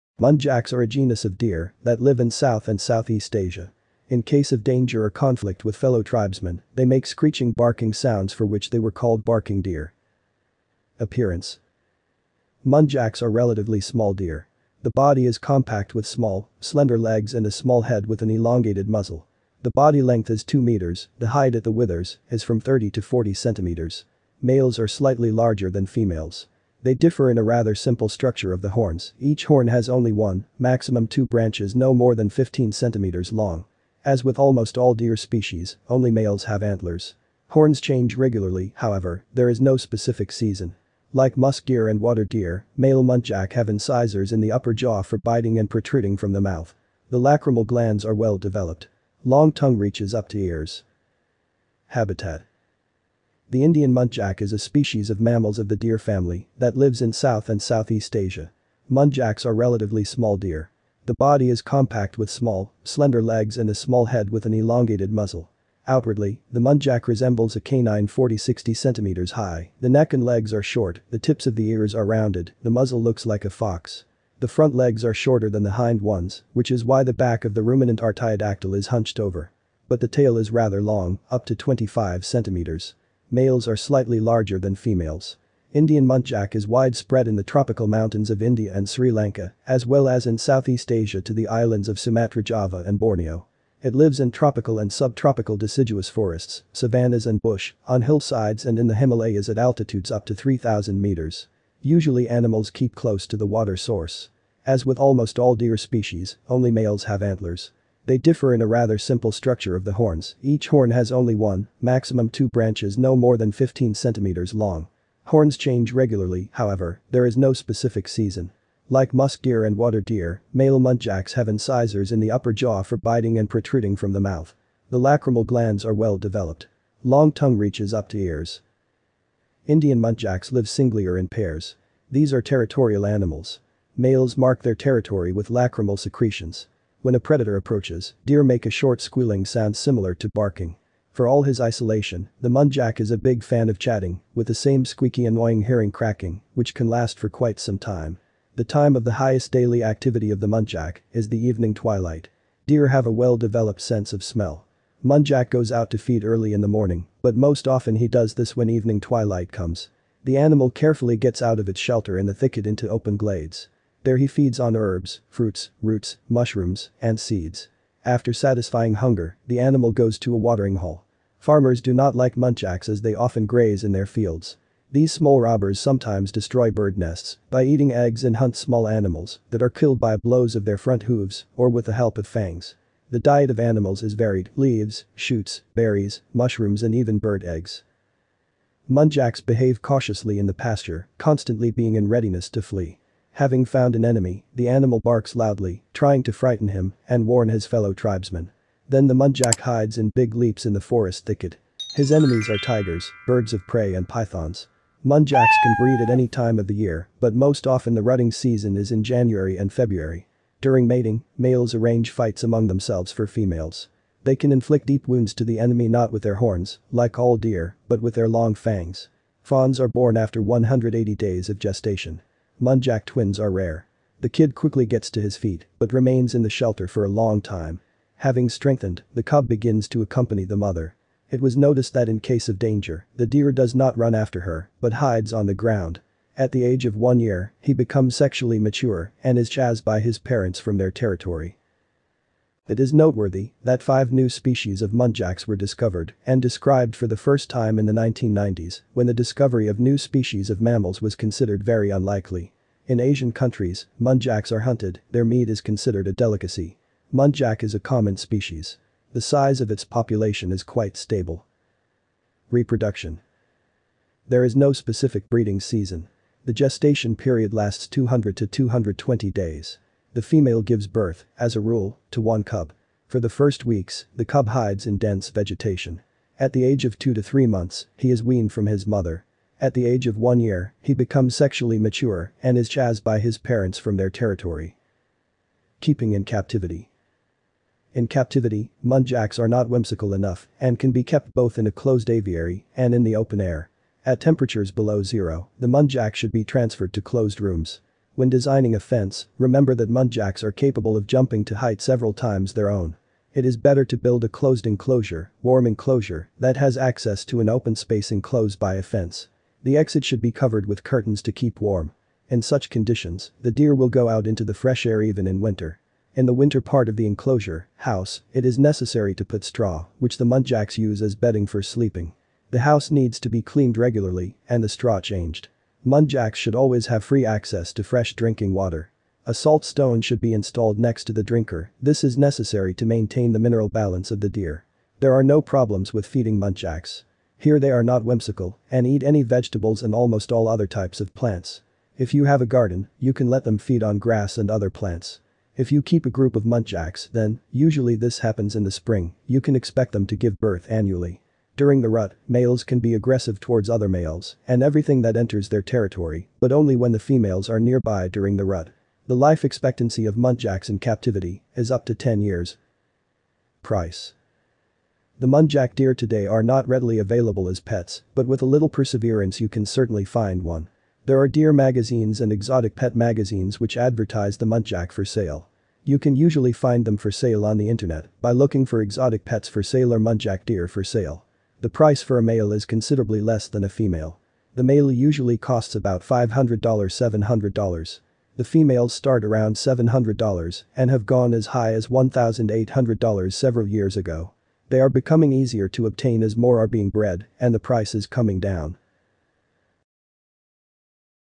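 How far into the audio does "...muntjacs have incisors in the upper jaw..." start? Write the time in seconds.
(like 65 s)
120 s.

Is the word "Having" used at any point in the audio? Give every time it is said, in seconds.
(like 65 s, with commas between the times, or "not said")
193 s, 228 s.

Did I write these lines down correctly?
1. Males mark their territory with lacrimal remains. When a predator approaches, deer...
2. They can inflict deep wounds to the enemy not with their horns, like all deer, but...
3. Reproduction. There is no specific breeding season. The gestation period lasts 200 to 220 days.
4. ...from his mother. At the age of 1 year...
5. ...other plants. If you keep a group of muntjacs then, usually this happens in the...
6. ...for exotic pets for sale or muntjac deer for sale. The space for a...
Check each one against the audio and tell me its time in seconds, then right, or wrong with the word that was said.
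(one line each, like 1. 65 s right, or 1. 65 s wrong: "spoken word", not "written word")
1. 133 s wrong: "secretions", not "remains"
2. 214 s right
3. 262 s right
4. 278 s right
5. 344 s right
6. 378 s wrong: "price", not "space".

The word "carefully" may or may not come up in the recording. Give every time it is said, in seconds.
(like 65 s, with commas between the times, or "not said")
160 s.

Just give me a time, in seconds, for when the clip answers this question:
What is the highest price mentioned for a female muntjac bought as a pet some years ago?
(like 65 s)
391 s.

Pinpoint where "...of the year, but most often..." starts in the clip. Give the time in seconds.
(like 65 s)
206 s.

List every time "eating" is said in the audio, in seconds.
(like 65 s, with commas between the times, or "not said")
177 s.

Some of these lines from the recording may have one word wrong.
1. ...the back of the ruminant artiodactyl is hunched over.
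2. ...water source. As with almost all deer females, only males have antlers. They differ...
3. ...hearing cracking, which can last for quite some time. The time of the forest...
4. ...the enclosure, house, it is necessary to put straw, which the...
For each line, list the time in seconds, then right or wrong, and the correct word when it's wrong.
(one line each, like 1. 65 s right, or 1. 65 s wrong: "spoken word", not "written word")
1. 77 s right
2. 103 s wrong: "species", not "females"
3. 145 s wrong: "highest", not "forest"
4. 316 s right.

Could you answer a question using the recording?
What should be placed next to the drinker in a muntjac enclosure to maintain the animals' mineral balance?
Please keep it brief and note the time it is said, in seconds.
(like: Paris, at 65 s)
salt stone, at 329 s.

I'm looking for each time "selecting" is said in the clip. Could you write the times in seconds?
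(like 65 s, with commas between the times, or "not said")
not said.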